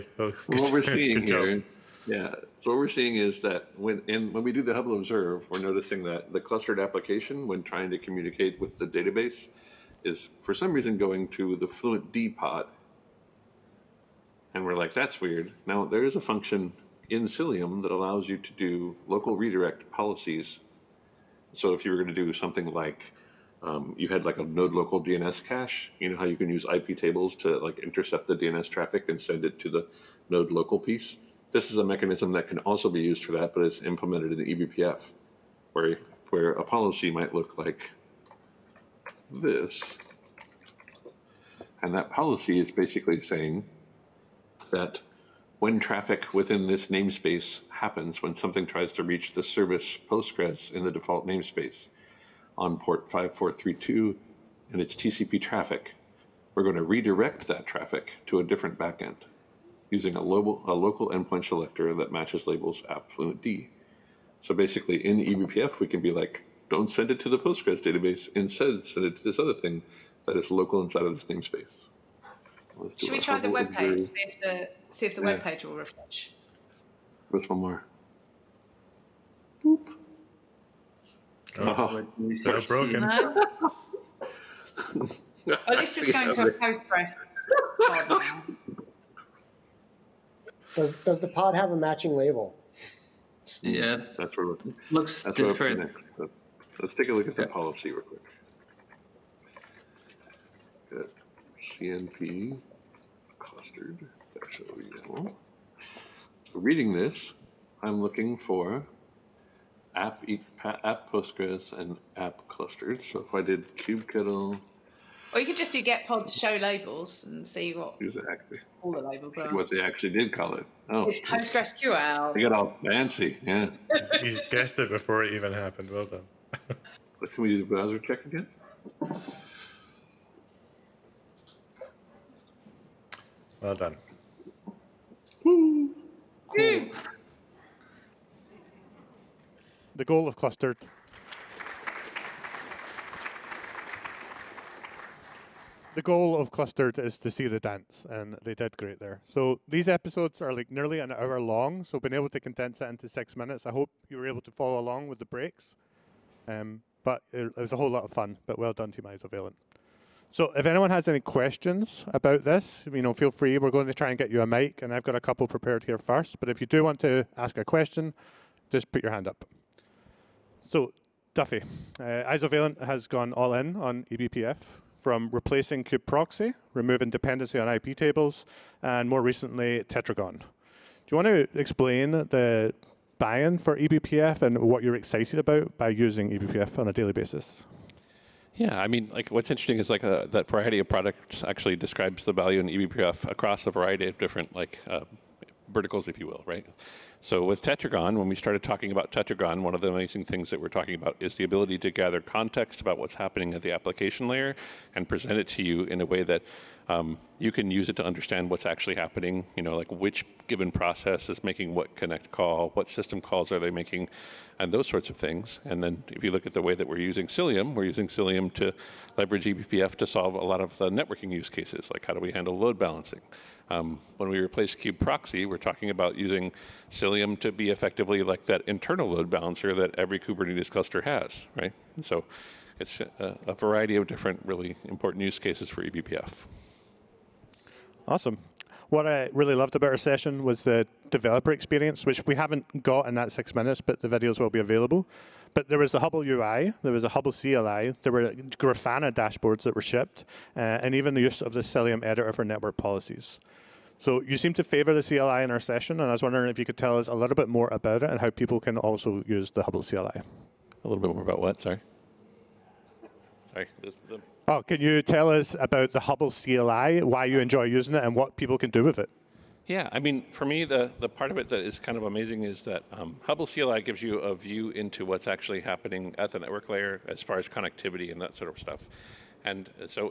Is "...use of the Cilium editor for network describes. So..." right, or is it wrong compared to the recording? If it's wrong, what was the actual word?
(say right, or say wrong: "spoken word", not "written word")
wrong: "policies", not "describes".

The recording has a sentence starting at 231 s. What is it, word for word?
And so it's a, a variety of different really important use cases for eBPF.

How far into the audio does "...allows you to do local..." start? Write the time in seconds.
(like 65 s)
17 s.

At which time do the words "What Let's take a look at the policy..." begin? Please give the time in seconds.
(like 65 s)
96 s.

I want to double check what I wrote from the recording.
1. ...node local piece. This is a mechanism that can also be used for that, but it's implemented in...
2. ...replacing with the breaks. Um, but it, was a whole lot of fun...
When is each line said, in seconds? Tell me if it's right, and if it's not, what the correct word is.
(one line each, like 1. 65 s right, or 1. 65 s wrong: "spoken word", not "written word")
1. 30 s right
2. 154 s wrong: "along", not "replacing".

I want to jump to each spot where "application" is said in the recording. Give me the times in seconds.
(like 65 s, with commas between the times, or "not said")
6 s, 203 s.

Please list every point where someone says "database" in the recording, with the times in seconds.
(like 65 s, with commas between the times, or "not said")
8 s, 67 s.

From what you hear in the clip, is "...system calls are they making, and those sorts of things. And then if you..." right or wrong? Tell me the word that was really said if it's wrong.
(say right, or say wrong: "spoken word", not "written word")
right.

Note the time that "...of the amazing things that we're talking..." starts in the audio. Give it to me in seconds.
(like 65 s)
199 s.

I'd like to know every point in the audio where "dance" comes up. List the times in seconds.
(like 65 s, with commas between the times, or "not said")
147 s.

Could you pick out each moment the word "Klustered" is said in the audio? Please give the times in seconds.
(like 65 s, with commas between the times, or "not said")
140 s, 146 s.